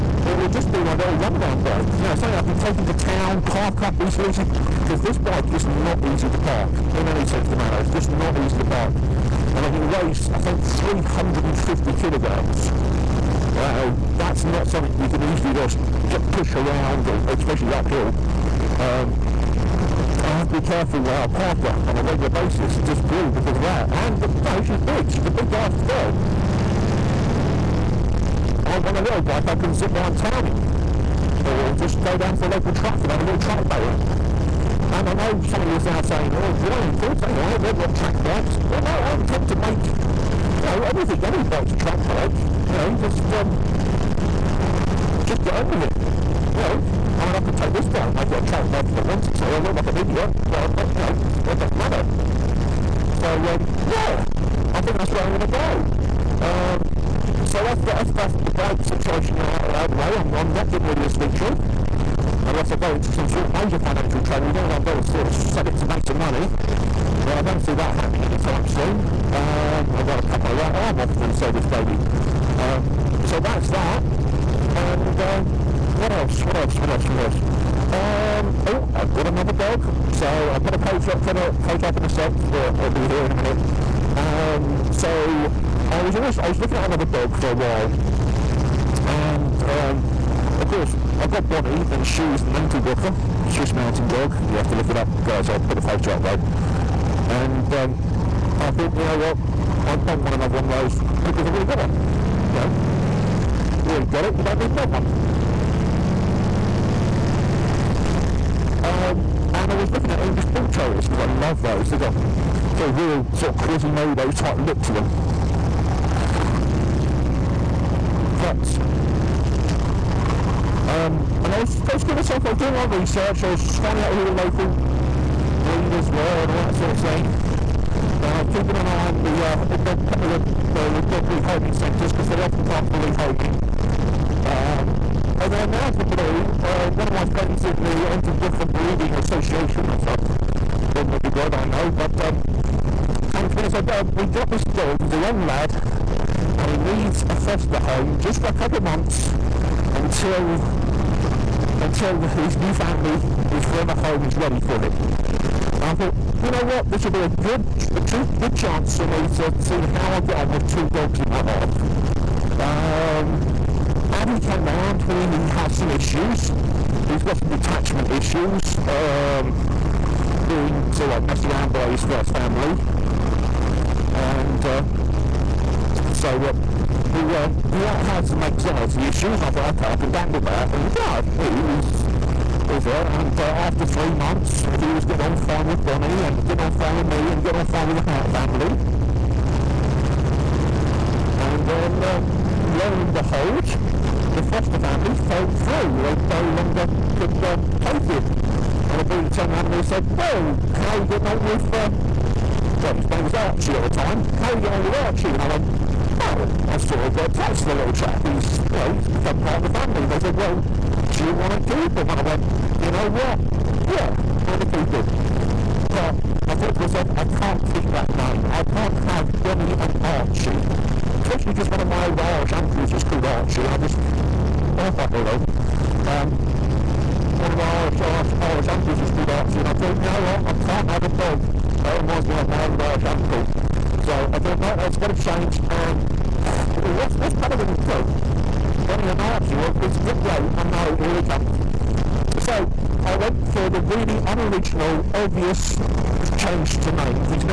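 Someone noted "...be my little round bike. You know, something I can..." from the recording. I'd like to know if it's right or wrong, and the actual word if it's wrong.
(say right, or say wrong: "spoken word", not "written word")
wrong: "runaround", not "round".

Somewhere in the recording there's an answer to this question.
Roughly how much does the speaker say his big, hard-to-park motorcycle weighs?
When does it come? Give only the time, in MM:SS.
00:10.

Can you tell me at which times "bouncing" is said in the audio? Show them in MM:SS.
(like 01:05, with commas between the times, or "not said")
not said.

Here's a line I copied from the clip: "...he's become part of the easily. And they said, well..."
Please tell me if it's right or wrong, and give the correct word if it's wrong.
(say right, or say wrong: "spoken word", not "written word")
wrong: "family", not "easily".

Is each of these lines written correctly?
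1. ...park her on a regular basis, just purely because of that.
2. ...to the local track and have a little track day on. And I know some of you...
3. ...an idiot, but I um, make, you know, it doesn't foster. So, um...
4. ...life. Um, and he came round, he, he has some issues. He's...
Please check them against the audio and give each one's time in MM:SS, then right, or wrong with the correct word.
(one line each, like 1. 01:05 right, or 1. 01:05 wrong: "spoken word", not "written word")
1. 00:21 right
2. 00:32 right
3. 00:49 wrong: "matter", not "foster"
4. 02:41 right.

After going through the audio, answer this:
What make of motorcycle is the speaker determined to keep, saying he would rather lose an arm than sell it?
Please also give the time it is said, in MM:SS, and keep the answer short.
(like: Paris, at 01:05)
Victory, at 01:01.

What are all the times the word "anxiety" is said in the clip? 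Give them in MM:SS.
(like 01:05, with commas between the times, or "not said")
02:58.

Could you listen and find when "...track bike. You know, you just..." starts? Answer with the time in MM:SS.
00:41.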